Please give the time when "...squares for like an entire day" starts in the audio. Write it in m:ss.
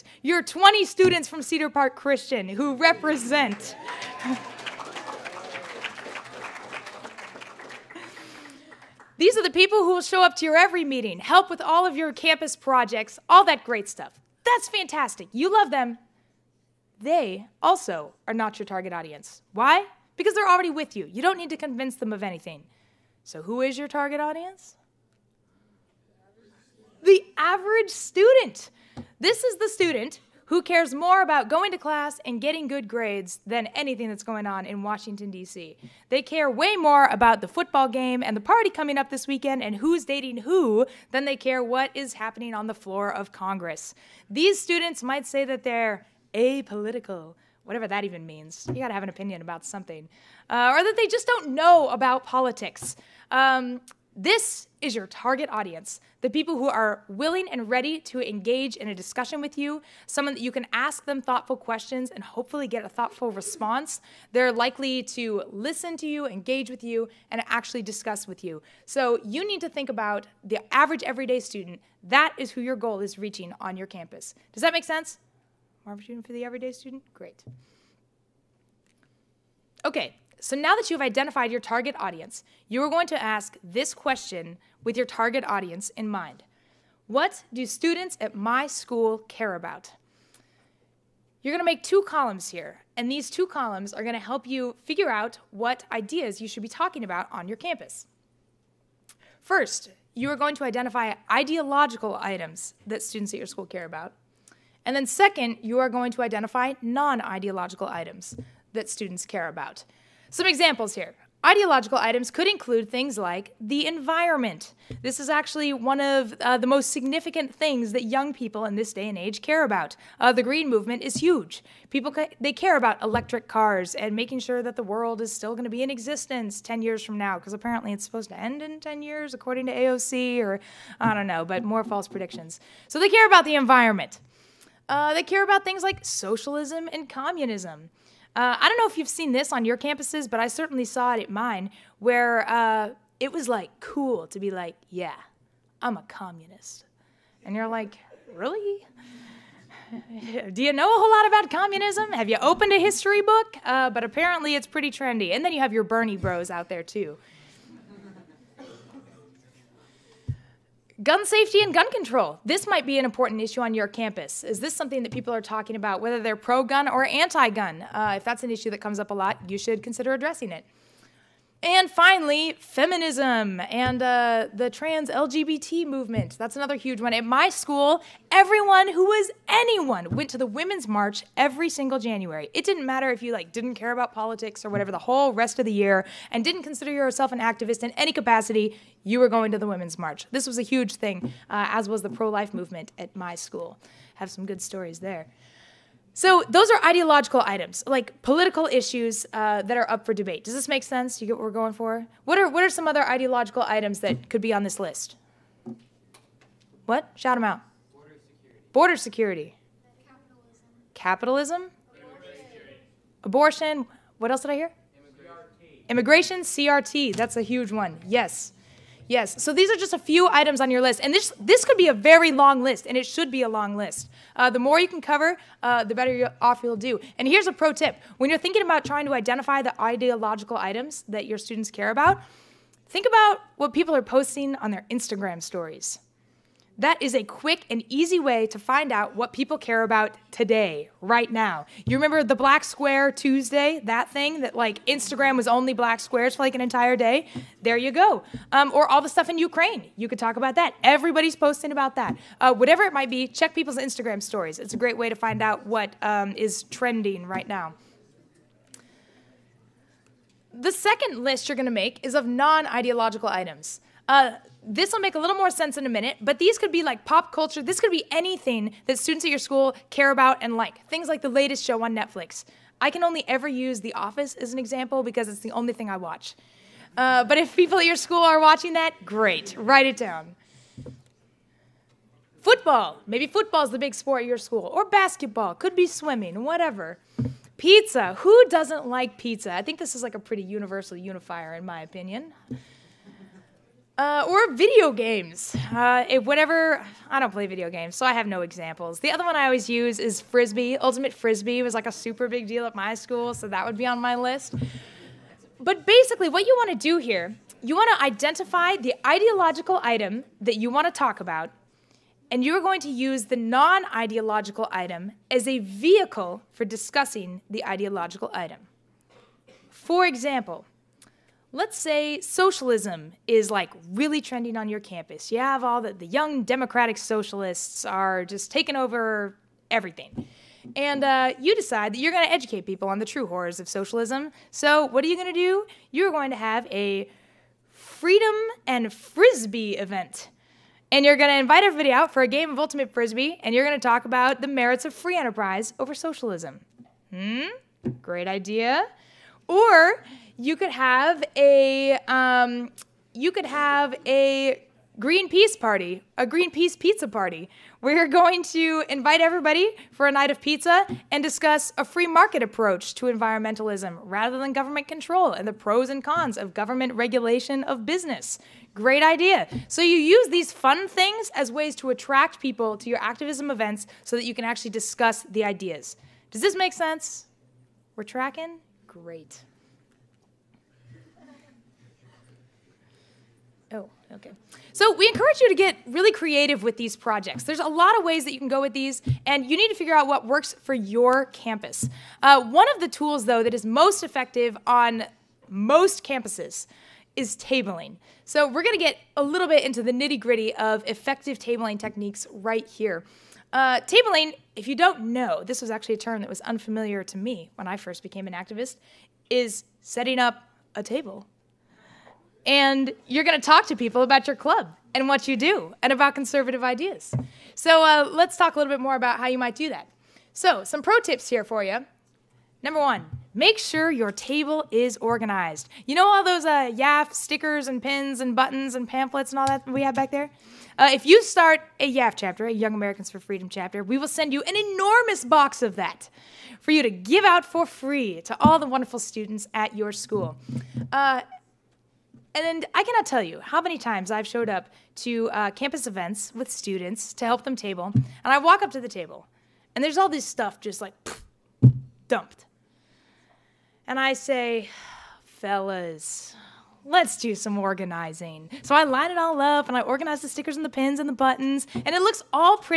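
4:05.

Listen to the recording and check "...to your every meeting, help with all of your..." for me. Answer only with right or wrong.
right.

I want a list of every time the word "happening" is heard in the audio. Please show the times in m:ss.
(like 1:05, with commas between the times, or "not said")
0:42.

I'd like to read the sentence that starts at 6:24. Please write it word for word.
So we encourage you to get really creative with these projects.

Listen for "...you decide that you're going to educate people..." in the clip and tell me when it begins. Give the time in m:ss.
5:31.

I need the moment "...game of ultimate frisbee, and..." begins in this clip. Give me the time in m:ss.
5:42.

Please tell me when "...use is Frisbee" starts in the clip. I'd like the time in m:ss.
4:59.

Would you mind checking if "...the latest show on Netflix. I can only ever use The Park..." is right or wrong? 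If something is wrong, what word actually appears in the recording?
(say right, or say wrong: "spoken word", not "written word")
wrong: "Office", not "Park".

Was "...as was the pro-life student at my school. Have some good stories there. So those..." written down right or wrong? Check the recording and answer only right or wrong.
wrong.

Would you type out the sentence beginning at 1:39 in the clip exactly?
First, you are going to identify ideological items that students at your school care about.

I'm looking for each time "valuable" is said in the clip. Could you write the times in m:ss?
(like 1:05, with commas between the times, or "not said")
not said.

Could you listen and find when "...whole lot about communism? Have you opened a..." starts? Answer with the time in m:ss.
2:30.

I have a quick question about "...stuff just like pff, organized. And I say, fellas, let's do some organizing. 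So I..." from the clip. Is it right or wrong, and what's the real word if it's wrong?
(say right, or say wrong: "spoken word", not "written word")
wrong: "dumped", not "organized".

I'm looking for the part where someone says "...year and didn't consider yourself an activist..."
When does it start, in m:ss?
3:05.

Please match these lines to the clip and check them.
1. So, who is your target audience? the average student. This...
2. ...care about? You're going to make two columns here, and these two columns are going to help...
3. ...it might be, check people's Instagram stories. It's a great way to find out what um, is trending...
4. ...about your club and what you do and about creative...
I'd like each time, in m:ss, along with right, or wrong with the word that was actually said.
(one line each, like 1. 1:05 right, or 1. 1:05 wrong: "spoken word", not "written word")
1. 0:23 right
2. 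1:29 right
3. 4:12 right
4. 6:54 wrong: "conservative", not "creative".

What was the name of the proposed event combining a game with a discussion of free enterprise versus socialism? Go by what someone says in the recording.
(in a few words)
Freedom and Frisbee.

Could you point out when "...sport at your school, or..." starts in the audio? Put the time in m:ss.
4:43.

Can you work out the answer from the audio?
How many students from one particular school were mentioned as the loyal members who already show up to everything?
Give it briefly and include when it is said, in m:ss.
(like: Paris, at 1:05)
20, at 0:00.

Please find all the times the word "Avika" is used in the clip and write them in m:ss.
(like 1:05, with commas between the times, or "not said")
not said.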